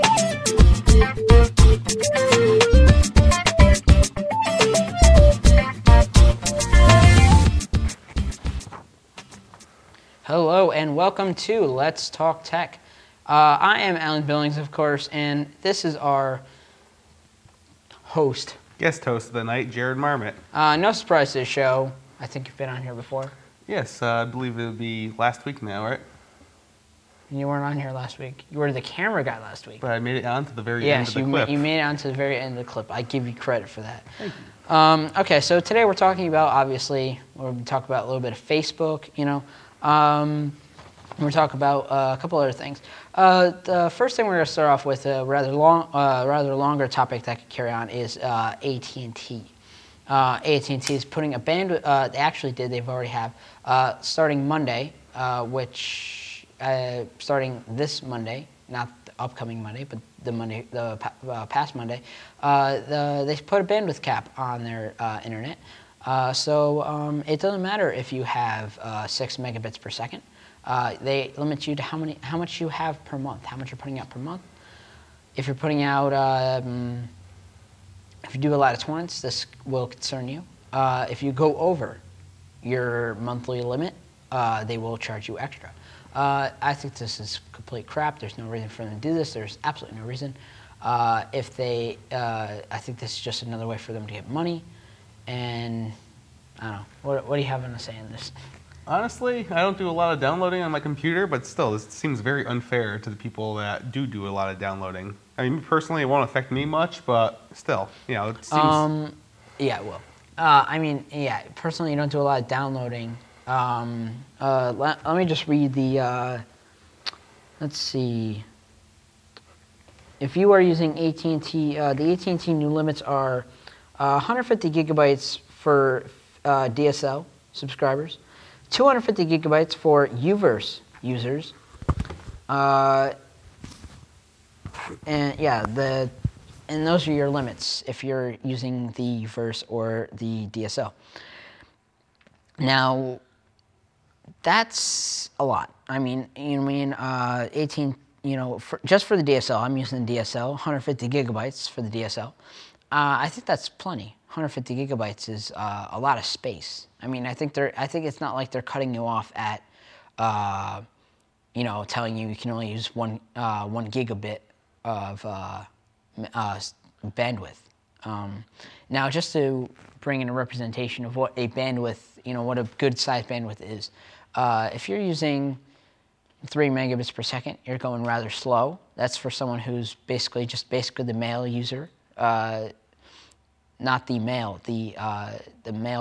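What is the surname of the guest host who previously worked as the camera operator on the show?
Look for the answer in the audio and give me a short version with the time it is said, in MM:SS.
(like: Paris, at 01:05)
Marmot, at 00:19.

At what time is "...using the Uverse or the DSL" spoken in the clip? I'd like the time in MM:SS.
02:18.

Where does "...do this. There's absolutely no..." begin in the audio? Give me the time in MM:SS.
01:29.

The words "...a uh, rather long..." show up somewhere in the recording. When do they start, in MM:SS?
00:45.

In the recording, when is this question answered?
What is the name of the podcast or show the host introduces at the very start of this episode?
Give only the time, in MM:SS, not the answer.
00:11.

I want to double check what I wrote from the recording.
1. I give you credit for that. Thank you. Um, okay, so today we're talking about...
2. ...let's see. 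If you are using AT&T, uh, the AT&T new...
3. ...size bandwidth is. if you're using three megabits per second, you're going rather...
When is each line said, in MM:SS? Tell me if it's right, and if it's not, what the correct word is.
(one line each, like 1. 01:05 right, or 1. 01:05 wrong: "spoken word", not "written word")
1. 00:32 right
2. 01:57 right
3. 02:52 right.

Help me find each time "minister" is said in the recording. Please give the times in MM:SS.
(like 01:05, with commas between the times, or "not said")
not said.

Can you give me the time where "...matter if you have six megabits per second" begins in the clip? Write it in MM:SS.
01:07.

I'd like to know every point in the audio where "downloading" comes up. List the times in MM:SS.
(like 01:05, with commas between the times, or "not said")
01:40, 01:44, 01:52.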